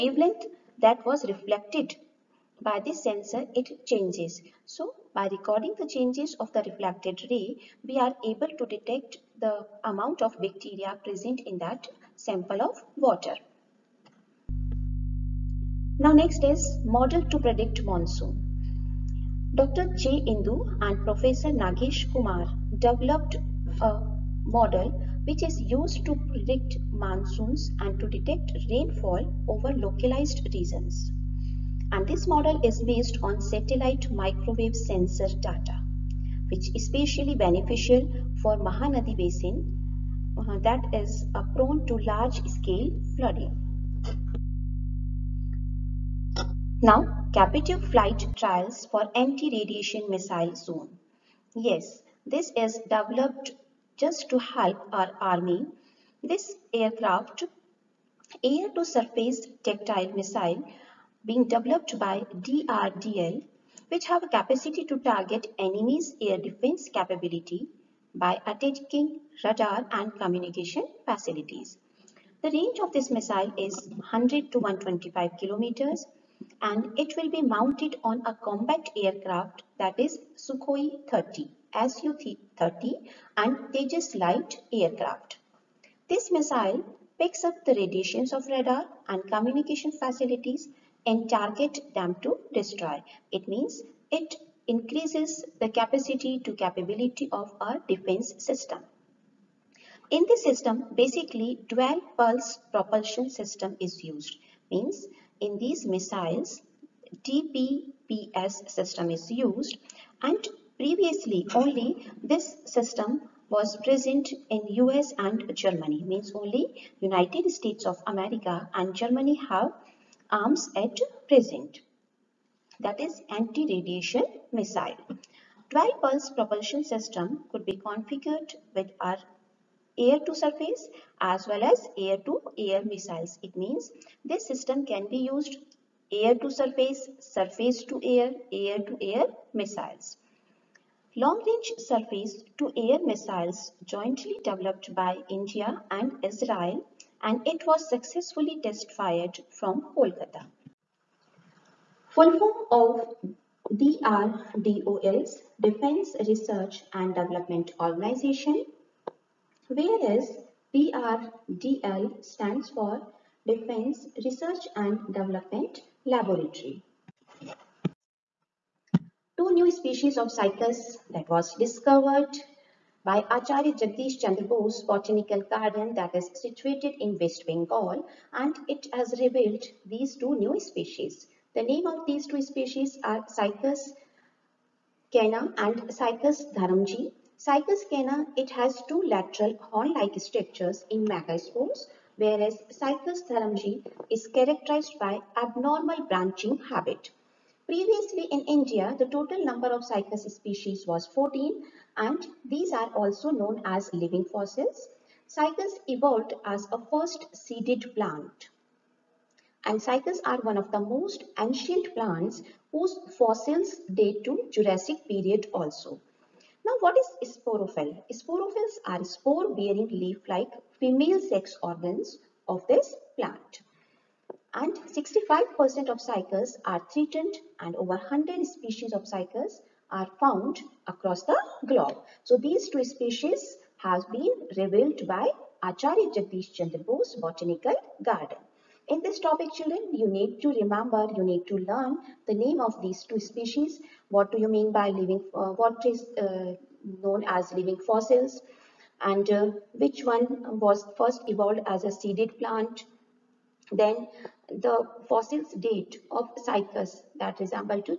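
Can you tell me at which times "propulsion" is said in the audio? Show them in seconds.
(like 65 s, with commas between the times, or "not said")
102 s, 126 s.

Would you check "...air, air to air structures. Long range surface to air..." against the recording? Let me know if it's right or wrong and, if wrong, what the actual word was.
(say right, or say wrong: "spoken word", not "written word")
wrong: "missiles", not "structures".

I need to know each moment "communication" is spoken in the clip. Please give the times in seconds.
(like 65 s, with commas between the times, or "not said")
70 s, 89 s.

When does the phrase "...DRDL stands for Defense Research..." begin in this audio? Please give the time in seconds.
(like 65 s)
160 s.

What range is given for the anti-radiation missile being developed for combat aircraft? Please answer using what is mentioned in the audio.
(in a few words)
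100 to 125 kilometers.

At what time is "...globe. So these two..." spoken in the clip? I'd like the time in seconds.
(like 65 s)
231 s.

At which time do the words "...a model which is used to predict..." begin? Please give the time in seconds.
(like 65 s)
23 s.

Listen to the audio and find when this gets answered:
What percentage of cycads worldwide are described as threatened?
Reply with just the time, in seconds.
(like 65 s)
224 s.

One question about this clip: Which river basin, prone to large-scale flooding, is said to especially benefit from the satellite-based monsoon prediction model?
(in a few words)
Mahanadi Basin.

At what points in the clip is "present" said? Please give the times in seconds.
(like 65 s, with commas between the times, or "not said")
11 s, 113 s, 121 s.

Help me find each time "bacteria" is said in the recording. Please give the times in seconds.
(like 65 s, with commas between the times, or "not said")
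10 s.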